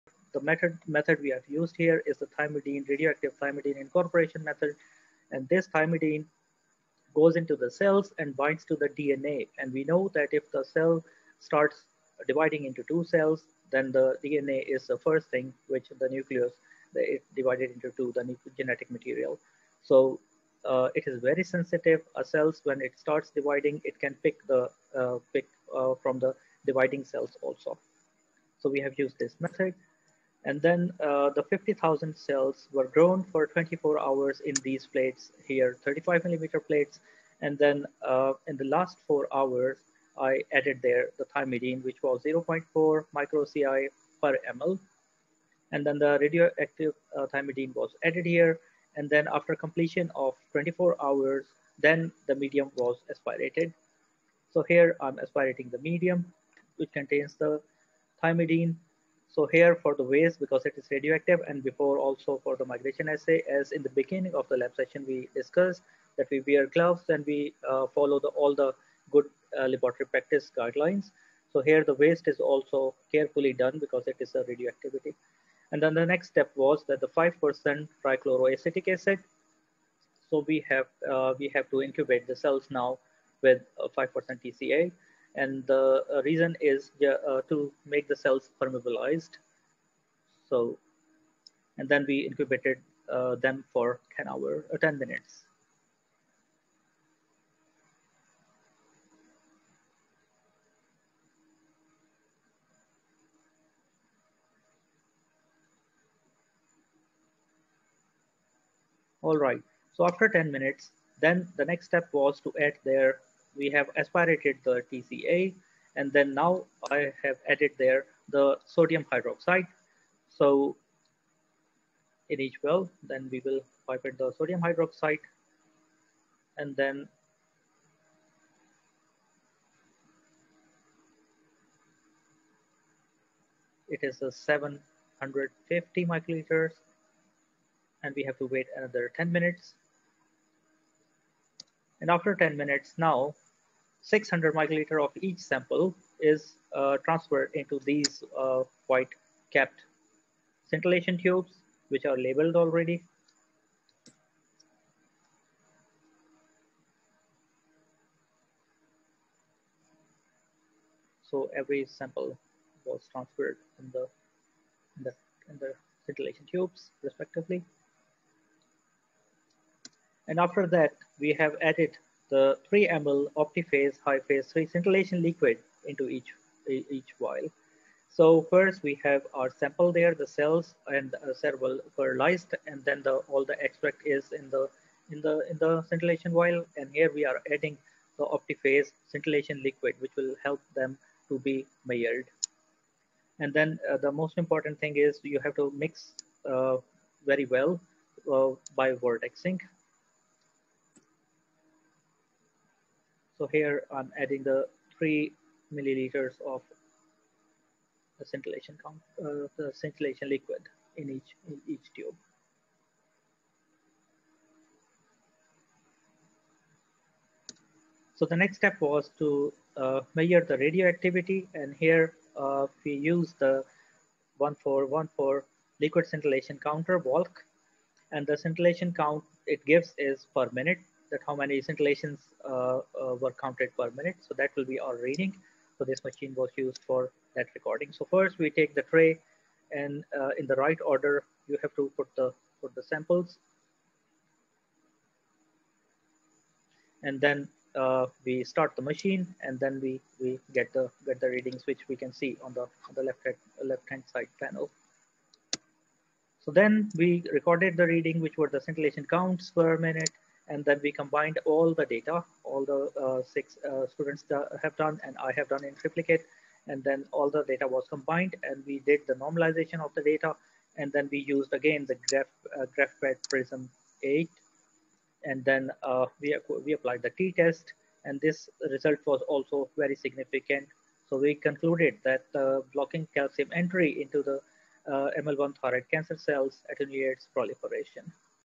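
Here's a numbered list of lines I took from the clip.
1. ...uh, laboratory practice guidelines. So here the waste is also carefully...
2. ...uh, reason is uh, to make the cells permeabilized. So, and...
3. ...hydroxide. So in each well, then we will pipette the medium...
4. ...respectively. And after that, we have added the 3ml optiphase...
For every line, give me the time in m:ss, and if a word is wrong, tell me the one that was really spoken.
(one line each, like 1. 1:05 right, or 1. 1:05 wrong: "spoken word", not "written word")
1. 1:09 right
2. 1:26 right
3. 1:59 wrong: "sodium", not "medium"
4. 2:47 right.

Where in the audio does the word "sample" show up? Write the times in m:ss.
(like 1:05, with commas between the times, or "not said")
2:25, 2:41, 2:59, 4:02.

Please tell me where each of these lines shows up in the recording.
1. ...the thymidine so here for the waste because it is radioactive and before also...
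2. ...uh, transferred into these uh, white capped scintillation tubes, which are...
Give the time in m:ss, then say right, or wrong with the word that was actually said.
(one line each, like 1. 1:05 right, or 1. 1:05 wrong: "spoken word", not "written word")
1. 0:57 right
2. 2:26 right.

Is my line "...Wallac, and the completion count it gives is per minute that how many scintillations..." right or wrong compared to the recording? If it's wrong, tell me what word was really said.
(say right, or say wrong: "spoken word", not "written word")
wrong: "scintillation", not "completion".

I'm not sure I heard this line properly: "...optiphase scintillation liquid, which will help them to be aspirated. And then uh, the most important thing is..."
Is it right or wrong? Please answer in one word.
wrong.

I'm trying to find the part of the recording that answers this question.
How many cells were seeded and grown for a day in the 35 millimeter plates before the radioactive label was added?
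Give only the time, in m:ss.
0:31.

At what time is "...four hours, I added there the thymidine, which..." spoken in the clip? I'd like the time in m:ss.
0:39.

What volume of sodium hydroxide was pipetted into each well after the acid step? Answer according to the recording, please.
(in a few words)
750 microliters.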